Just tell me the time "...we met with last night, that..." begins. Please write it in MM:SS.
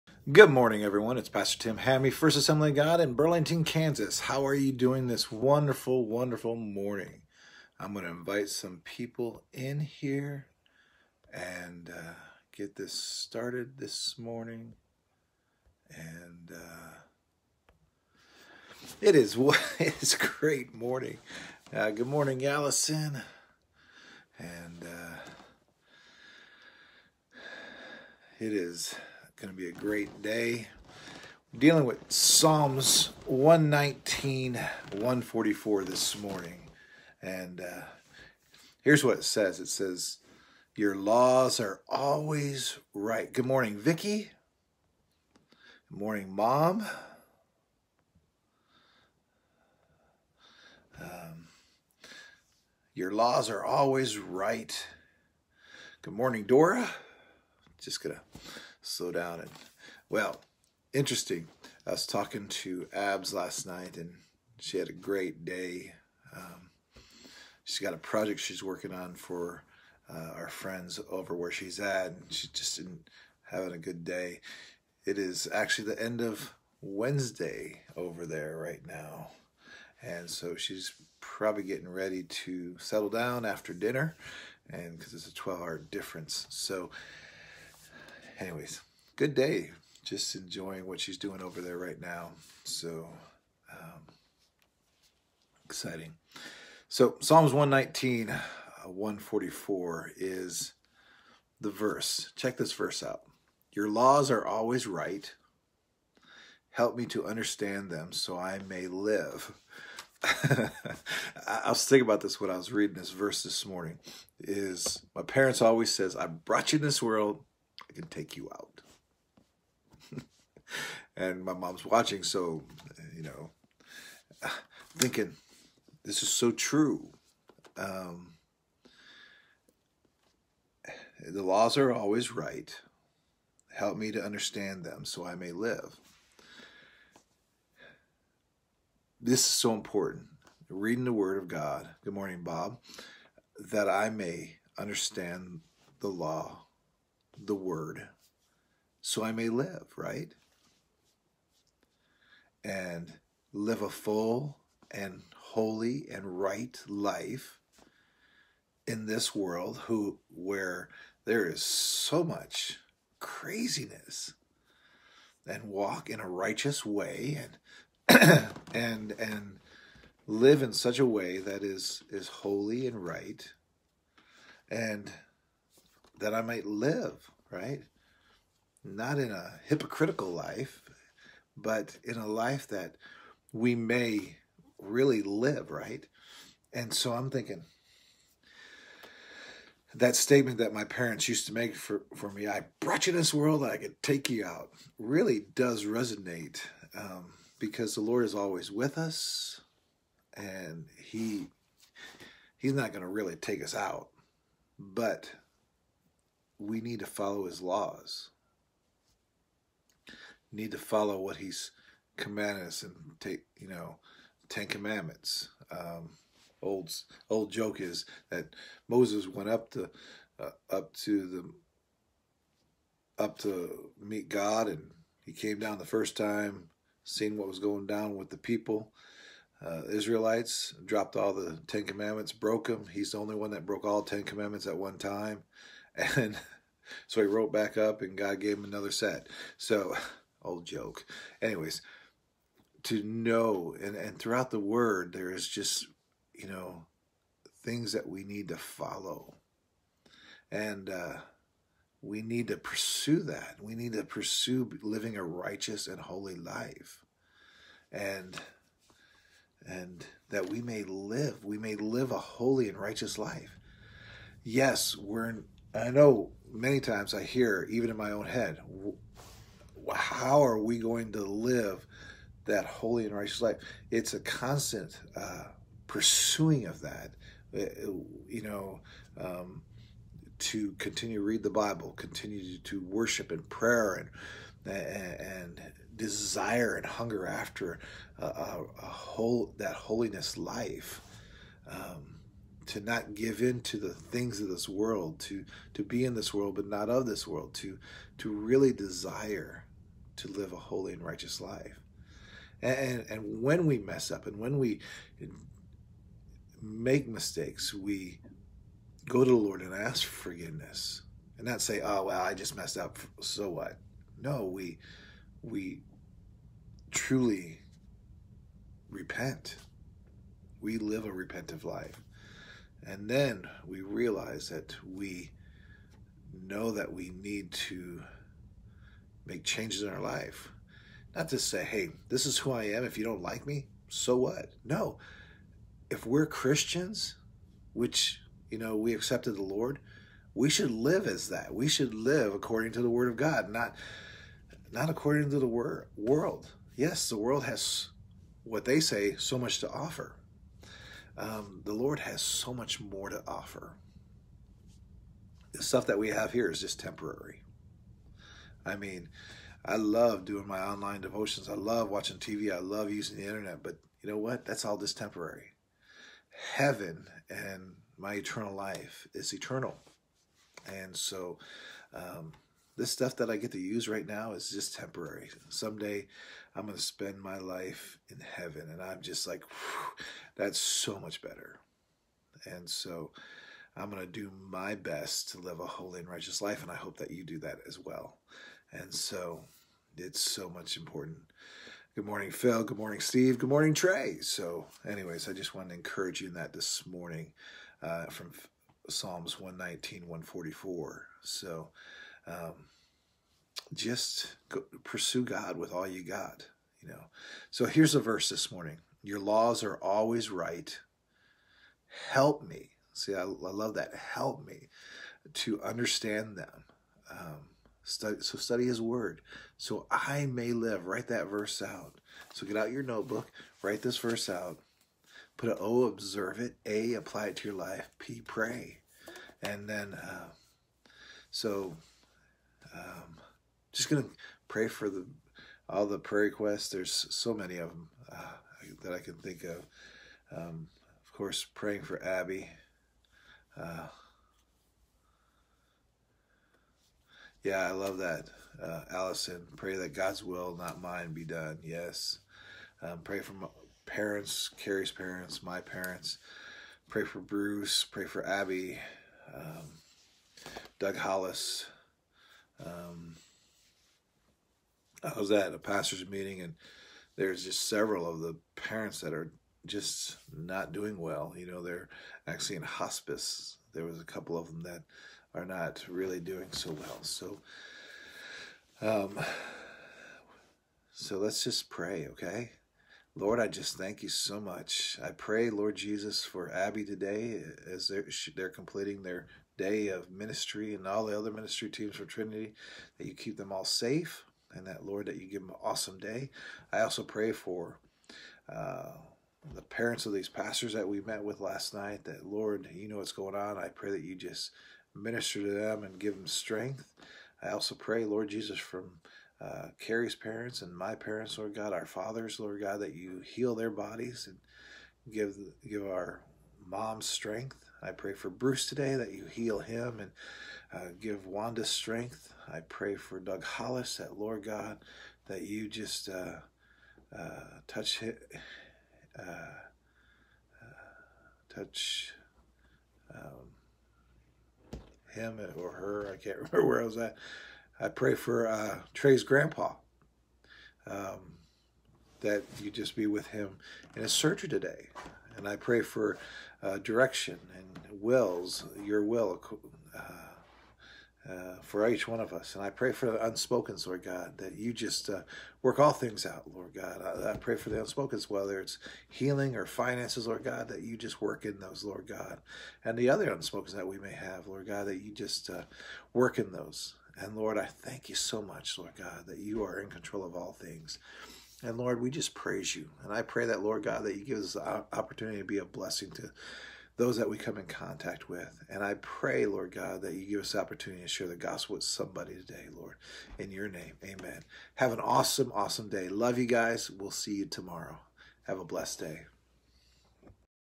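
08:20.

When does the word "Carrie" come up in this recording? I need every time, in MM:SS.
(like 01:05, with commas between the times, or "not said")
07:34, 08:29.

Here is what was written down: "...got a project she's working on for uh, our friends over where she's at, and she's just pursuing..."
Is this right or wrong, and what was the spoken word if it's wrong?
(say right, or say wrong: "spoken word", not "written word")
wrong: "having", not "pursuing".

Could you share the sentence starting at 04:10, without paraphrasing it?
And uh, we need to pursue that.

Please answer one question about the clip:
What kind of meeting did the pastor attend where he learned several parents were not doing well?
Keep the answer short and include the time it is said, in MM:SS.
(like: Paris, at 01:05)
Pastor's meeting, at 07:45.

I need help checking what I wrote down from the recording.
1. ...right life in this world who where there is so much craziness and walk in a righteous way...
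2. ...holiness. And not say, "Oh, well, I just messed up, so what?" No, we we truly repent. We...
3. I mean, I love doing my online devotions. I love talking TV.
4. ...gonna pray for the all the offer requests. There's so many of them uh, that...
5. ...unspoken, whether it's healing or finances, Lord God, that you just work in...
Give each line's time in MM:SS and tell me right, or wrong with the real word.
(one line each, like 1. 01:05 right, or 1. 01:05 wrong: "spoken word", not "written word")
1. 02:36 right
2. 05:10 wrong: "forgiveness", not "holiness"
3. 05:58 wrong: "watching", not "talking"
4. 07:13 wrong: "prayer", not "offer"
5. 09:17 right.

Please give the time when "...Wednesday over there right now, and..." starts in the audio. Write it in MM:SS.
01:16.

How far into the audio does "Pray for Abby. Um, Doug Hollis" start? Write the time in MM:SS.
07:37.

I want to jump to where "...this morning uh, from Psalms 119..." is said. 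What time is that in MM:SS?
06:36.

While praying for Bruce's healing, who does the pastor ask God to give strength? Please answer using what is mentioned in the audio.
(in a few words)
Wanda.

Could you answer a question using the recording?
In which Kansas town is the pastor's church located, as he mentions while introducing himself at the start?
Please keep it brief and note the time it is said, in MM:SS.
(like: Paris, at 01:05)
Burlington, at 00:03.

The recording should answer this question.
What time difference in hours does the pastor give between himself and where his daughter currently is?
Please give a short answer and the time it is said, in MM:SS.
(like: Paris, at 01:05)
12, at 01:25.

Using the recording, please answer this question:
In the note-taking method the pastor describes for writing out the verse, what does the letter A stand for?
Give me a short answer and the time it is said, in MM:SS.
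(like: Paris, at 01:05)
Apply, at 07:06.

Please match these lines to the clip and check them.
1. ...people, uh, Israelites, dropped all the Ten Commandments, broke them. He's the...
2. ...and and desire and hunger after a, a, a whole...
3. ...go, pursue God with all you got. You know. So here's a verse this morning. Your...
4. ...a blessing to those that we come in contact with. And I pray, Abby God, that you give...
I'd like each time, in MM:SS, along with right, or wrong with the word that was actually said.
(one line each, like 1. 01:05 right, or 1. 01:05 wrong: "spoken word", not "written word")
1. 03:48 right
2. 04:44 right
3. 06:44 right
4. 09:35 wrong: "Lord", not "Abby".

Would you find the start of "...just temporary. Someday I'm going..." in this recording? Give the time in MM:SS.
06:14.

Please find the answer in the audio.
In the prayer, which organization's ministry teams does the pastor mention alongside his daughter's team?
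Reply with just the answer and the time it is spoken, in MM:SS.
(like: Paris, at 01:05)
Trinity, at 08:12.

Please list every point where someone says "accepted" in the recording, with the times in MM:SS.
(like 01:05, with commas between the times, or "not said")
05:38.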